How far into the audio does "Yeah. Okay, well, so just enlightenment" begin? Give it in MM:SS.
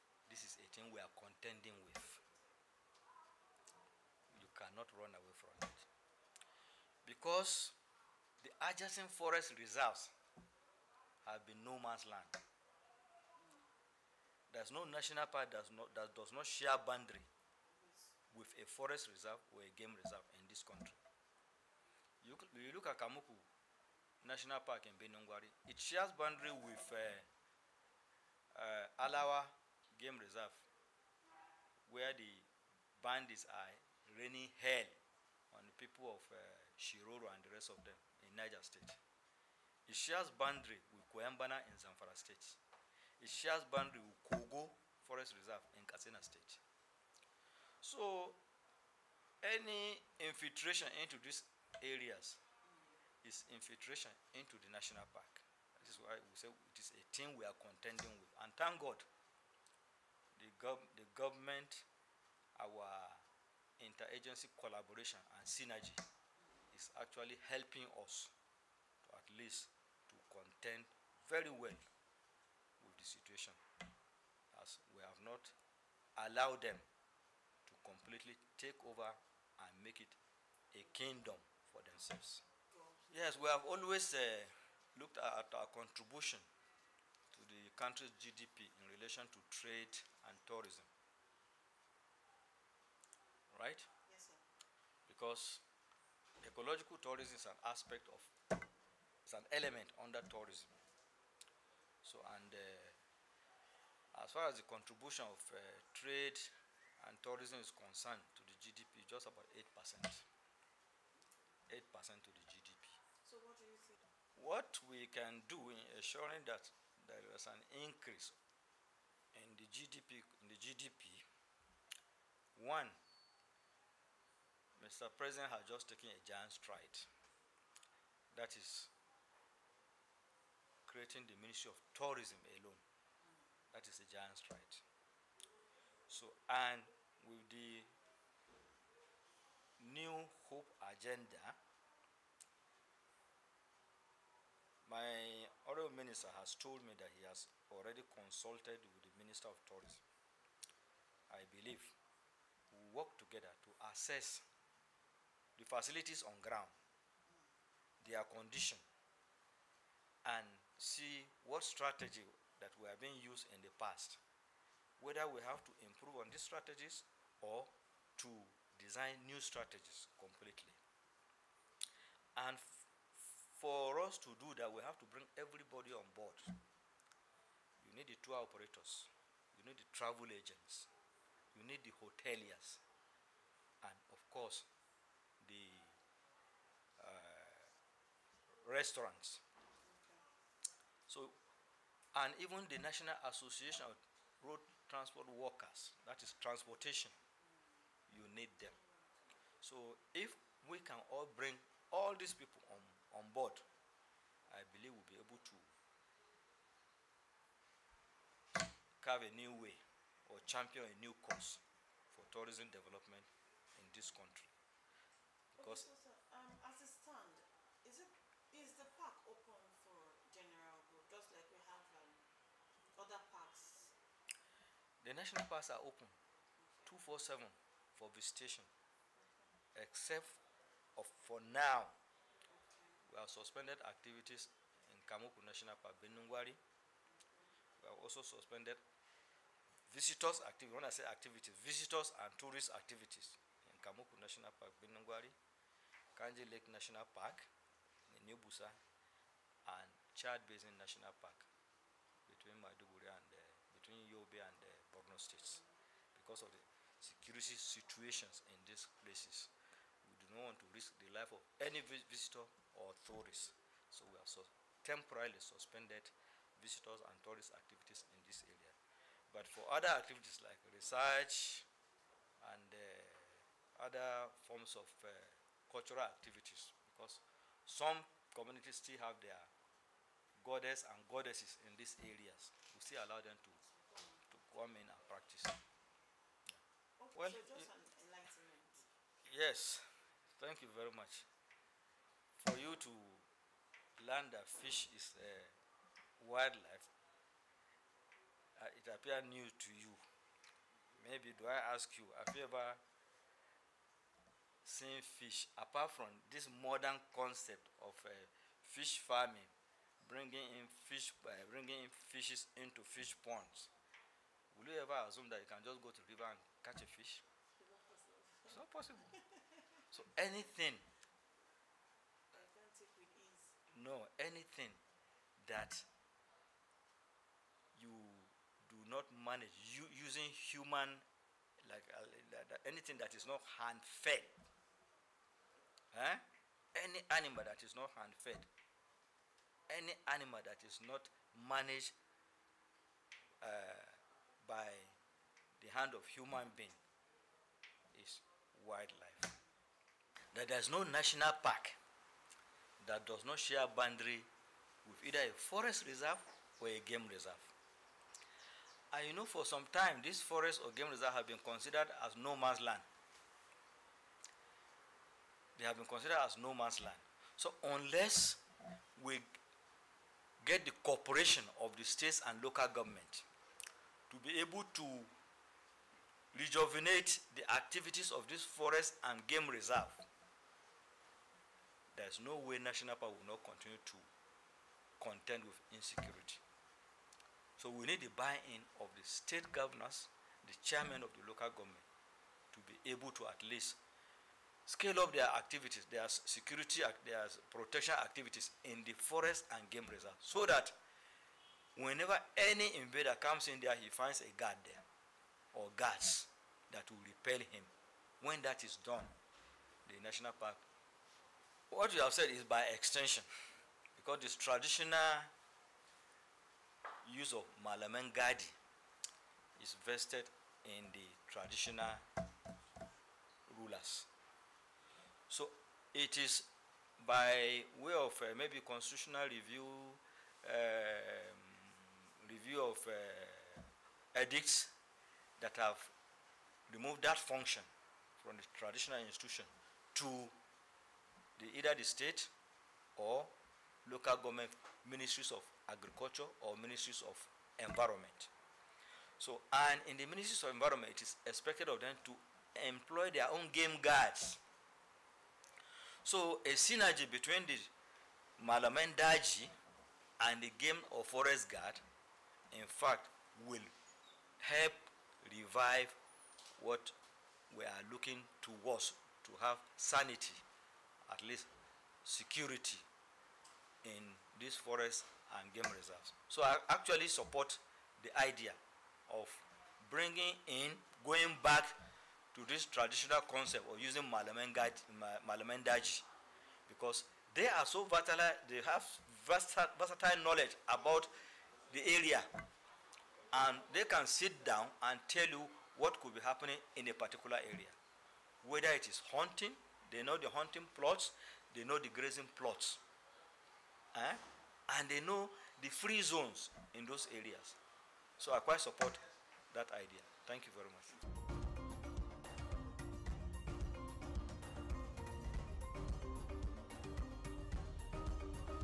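04:45.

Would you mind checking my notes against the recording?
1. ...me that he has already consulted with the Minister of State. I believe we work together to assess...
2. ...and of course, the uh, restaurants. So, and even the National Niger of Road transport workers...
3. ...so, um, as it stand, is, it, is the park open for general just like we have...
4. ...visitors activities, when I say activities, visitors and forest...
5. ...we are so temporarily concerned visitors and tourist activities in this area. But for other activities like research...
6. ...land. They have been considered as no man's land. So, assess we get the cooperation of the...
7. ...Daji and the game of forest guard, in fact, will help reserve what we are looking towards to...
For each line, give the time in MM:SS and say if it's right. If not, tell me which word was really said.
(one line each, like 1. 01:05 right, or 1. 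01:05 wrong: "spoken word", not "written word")
1. 02:26 wrong: "Tourism", not "State"
2. 03:03 wrong: "Association", not "Niger"
3. 03:35 right
4. 03:59 wrong: "tourist", not "forest"
5. 04:24 wrong: "suspended", not "concerned"
6. 06:02 wrong: "unless", not "assess"
7. 07:38 wrong: "revive", not "reserve".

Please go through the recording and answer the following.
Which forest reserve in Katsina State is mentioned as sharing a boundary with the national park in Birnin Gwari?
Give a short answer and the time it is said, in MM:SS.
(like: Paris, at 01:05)
Kogo Forest Reserve, at 00:44.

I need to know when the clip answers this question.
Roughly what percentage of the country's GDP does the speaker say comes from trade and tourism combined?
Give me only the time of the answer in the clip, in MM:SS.
01:49.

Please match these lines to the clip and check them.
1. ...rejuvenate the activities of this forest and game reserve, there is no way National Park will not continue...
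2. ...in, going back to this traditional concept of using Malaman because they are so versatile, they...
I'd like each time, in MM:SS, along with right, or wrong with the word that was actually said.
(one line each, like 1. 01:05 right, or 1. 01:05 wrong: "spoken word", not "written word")
1. 06:16 right
2. 08:00 right.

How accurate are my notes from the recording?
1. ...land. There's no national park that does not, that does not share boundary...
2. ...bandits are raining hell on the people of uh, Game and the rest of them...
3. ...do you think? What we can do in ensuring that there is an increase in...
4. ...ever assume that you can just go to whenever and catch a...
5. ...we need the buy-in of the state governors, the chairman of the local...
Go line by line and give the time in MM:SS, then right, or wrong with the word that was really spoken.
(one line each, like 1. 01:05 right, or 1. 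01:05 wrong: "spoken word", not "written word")
1. 00:12 right
2. 00:33 wrong: "Shiroro", not "Game"
3. 01:53 right
4. 05:14 wrong: "river", not "whenever"
5. 06:27 right.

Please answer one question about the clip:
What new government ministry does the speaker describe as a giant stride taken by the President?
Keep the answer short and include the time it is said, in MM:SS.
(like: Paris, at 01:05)
Ministry of Tourism, at 02:11.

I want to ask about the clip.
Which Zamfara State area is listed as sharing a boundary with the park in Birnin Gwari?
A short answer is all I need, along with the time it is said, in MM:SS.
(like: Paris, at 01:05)
Kuyambana, at 00:41.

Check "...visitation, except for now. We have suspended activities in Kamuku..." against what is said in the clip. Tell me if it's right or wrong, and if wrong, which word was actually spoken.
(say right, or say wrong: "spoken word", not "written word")
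right.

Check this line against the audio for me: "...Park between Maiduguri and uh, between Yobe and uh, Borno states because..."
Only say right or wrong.
right.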